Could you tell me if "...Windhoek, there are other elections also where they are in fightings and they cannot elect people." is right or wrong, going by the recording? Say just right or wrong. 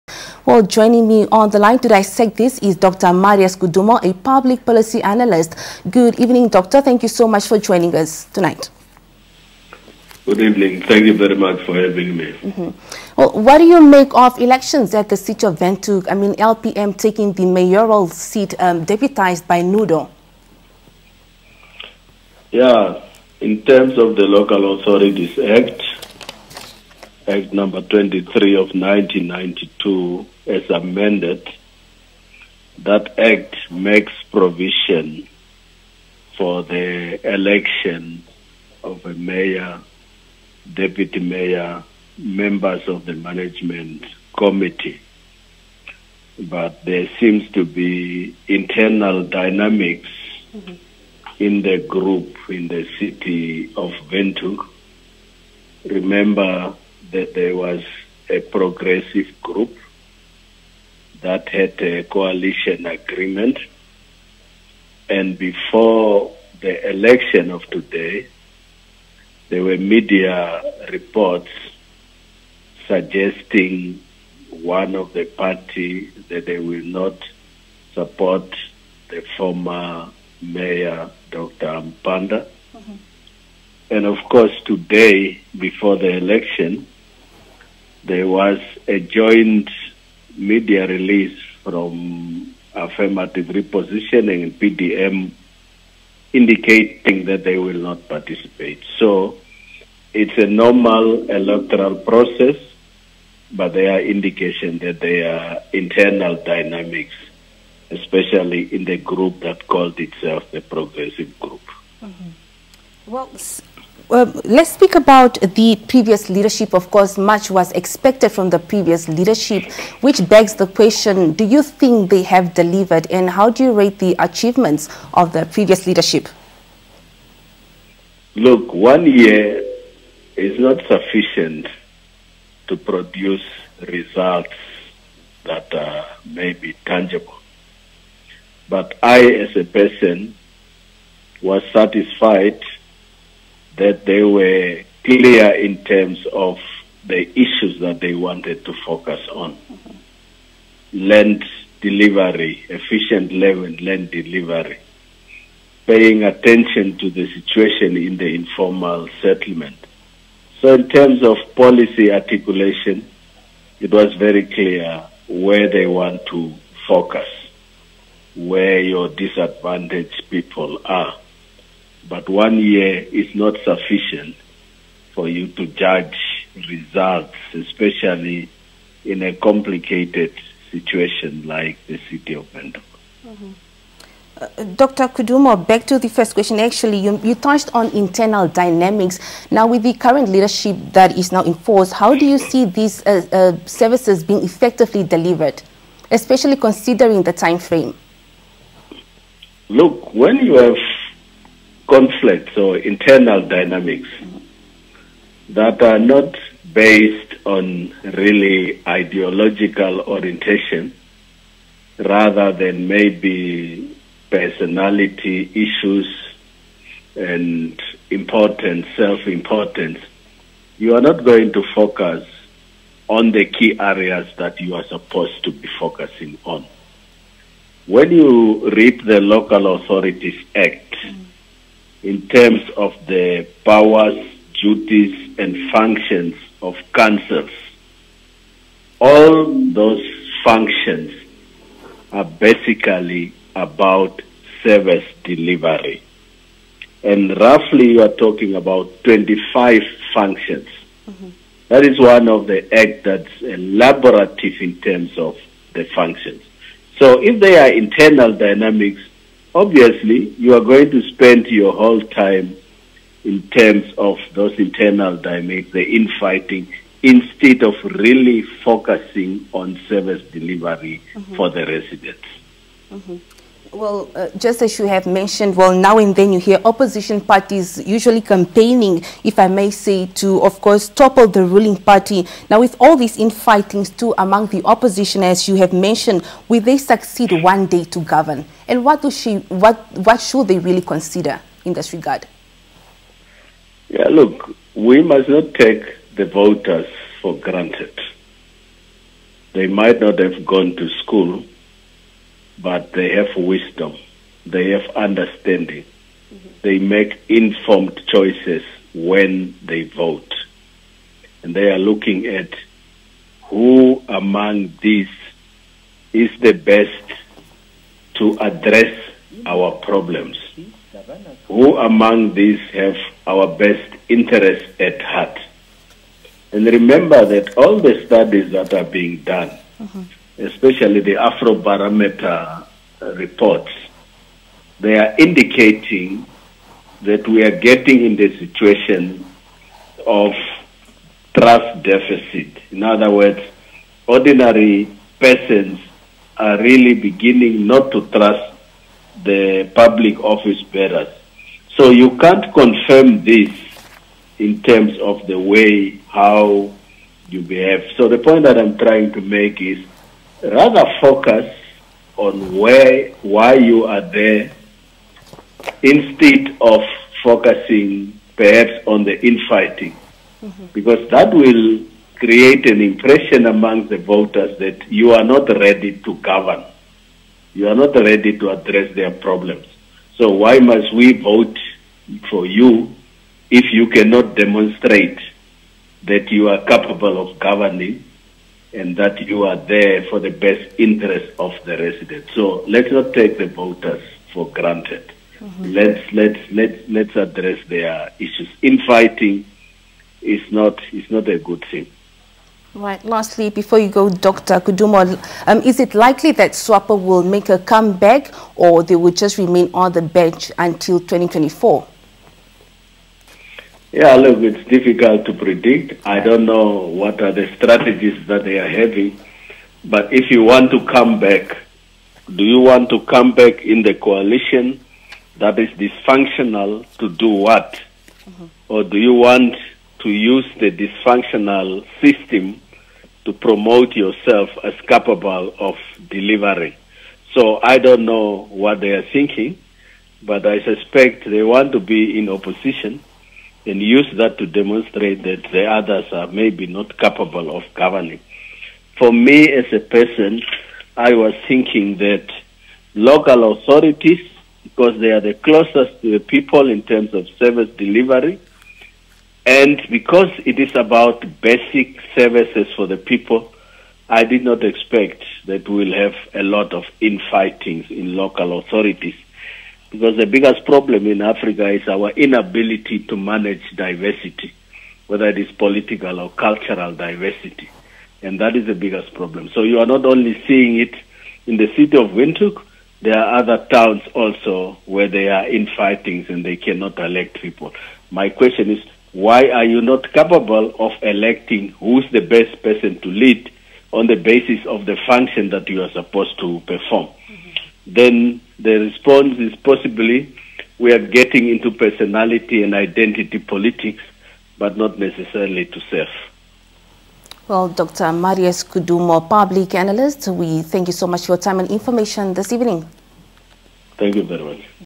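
wrong.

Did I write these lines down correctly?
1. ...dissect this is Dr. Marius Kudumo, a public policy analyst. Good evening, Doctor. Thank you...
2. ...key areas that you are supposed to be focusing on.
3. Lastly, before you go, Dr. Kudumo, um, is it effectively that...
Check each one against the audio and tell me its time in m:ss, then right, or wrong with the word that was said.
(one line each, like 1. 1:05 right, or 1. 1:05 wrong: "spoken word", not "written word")
1. 0:01 right
2. 3:43 right
3. 6:43 wrong: "likely", not "effectively".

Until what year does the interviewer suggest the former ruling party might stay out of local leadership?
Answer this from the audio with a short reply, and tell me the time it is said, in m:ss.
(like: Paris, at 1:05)
2024, at 6:51.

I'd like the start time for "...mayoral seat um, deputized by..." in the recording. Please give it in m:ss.
0:17.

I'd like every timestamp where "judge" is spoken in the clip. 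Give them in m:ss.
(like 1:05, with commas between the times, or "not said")
2:55.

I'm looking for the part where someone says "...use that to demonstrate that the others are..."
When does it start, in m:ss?
7:23.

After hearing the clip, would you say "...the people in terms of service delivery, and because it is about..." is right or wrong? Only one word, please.
right.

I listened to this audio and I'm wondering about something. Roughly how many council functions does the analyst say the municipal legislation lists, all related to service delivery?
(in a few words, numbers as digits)
25.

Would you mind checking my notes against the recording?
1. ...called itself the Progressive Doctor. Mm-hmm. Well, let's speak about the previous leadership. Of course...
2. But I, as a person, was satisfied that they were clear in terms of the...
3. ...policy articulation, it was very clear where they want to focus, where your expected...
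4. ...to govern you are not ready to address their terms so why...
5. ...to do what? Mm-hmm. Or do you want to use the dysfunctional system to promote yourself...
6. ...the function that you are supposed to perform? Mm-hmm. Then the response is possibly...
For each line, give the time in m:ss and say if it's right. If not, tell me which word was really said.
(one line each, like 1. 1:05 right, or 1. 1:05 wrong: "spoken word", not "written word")
1. 1:49 wrong: "Group", not "Doctor"
2. 2:18 right
3. 2:41 wrong: "disadvantaged", not "expected"
4. 6:16 wrong: "problems", not "terms"
5. 7:06 right
6. 8:14 right.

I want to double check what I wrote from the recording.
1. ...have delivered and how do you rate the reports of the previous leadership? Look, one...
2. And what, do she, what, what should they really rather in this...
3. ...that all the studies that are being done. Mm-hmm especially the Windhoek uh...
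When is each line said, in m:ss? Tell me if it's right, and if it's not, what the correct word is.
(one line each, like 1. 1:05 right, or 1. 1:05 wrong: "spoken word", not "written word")
1. 2:02 wrong: "achievements", not "reports"
2. 4:48 wrong: "consider", not "rather"
3. 5:27 wrong: "Afrobarometer", not "Windhoek".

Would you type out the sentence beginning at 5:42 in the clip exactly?
In other words, ordinary persons are really beginning not to trust the public office bearers.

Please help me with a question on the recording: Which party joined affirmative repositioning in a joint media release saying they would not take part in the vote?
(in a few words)
PDM.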